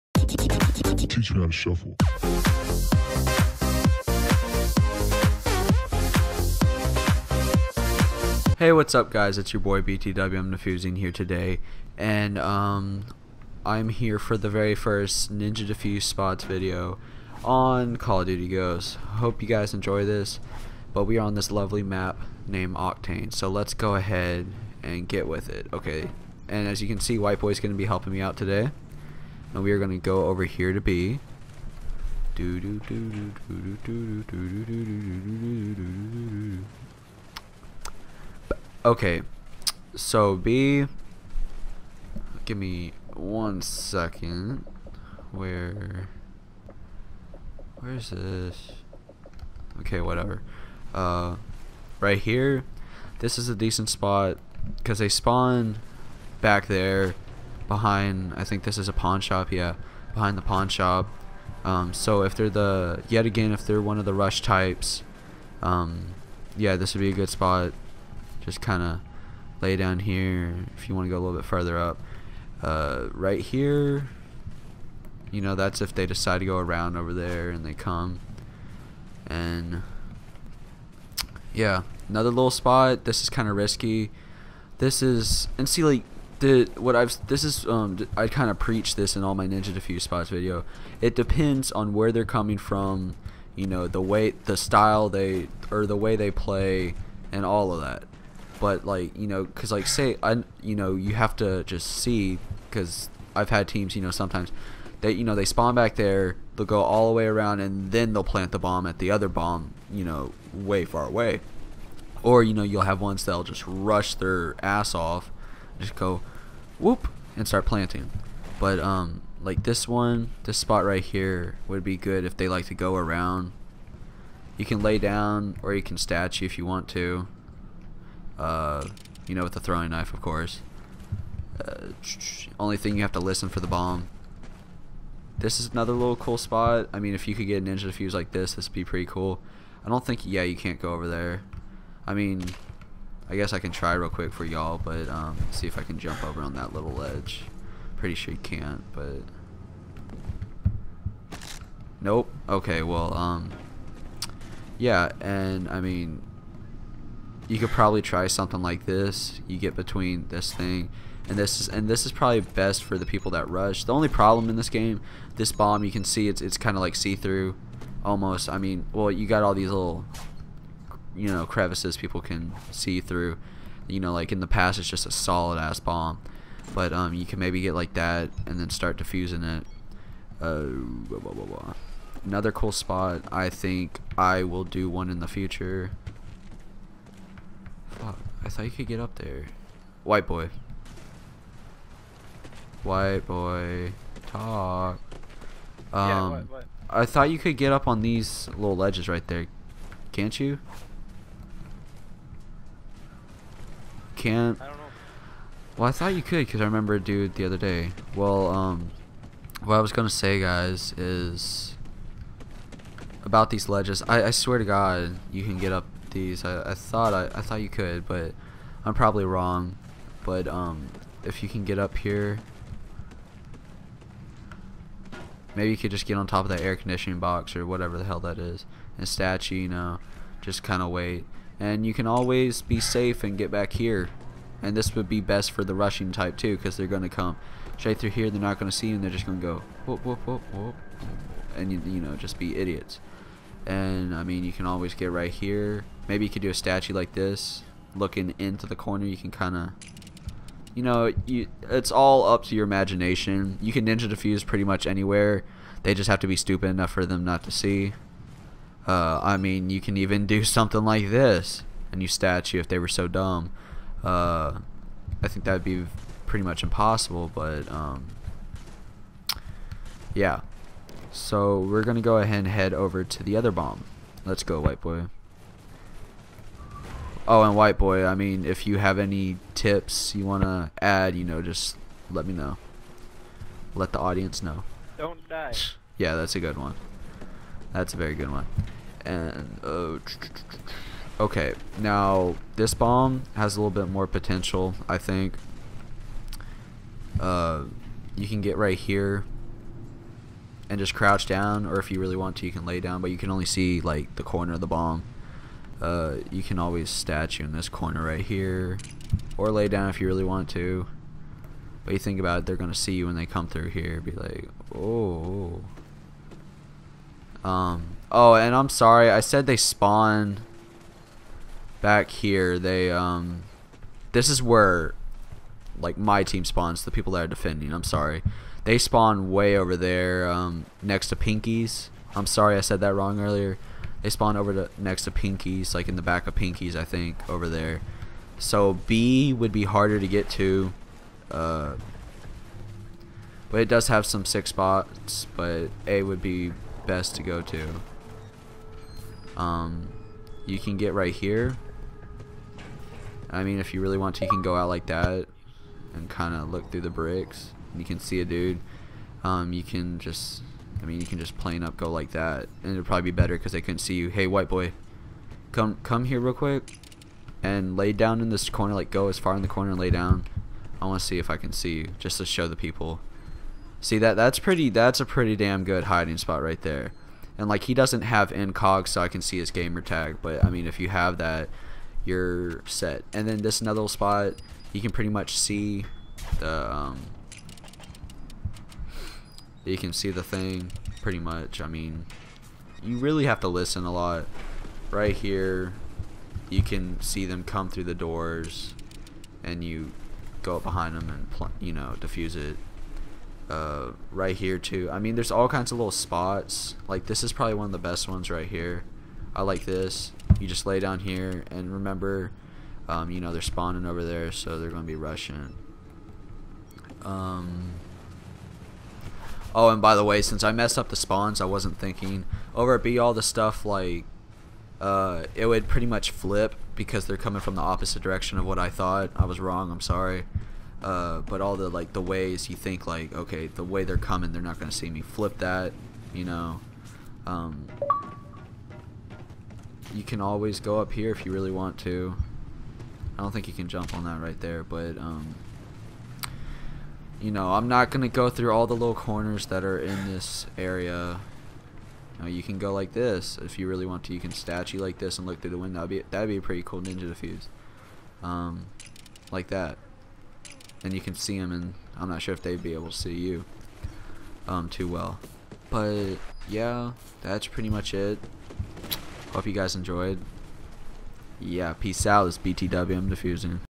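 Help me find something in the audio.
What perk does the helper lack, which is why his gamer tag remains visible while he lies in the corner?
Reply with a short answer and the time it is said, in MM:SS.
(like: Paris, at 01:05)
incog, at 06:18.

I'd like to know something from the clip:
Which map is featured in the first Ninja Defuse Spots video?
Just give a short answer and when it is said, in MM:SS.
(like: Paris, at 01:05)
Octane, at 00:22.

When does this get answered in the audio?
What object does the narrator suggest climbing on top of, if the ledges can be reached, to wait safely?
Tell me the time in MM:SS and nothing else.
03:46.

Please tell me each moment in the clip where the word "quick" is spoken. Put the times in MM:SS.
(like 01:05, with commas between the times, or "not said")
02:24, 06:06.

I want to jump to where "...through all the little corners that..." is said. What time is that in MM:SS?
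07:28.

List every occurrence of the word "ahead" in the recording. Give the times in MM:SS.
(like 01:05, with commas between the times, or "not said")
00:23, 04:32.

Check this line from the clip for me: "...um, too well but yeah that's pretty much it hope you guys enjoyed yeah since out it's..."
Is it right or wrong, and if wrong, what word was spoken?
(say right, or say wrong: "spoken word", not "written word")
wrong: "peace", not "since".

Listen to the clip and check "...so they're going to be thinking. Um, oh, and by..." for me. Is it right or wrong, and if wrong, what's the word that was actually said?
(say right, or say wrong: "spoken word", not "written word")
wrong: "rushing", not "thinking".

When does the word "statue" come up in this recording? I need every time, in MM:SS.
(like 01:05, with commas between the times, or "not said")
02:05, 03:49, 04:06, 04:22, 05:06, 07:34.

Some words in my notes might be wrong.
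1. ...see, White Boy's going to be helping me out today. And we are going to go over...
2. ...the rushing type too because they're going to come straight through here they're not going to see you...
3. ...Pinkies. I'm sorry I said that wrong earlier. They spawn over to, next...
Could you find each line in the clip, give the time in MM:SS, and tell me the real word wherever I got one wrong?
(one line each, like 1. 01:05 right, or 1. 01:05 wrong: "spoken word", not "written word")
1. 00:27 right
2. 03:55 right
3. 05:31 right.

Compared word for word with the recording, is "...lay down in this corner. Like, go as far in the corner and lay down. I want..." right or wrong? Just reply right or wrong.
right.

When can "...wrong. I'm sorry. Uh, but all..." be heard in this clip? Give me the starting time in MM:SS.
07:09.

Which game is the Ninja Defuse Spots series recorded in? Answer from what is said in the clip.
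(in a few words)
Call of Duty Ghosts.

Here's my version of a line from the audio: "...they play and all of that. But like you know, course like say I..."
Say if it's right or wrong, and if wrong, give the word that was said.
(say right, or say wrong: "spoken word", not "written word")
wrong: "cause", not "course".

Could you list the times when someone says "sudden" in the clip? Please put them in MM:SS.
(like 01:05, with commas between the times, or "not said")
not said.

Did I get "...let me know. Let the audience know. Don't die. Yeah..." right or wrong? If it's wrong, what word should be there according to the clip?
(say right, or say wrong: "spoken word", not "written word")
right.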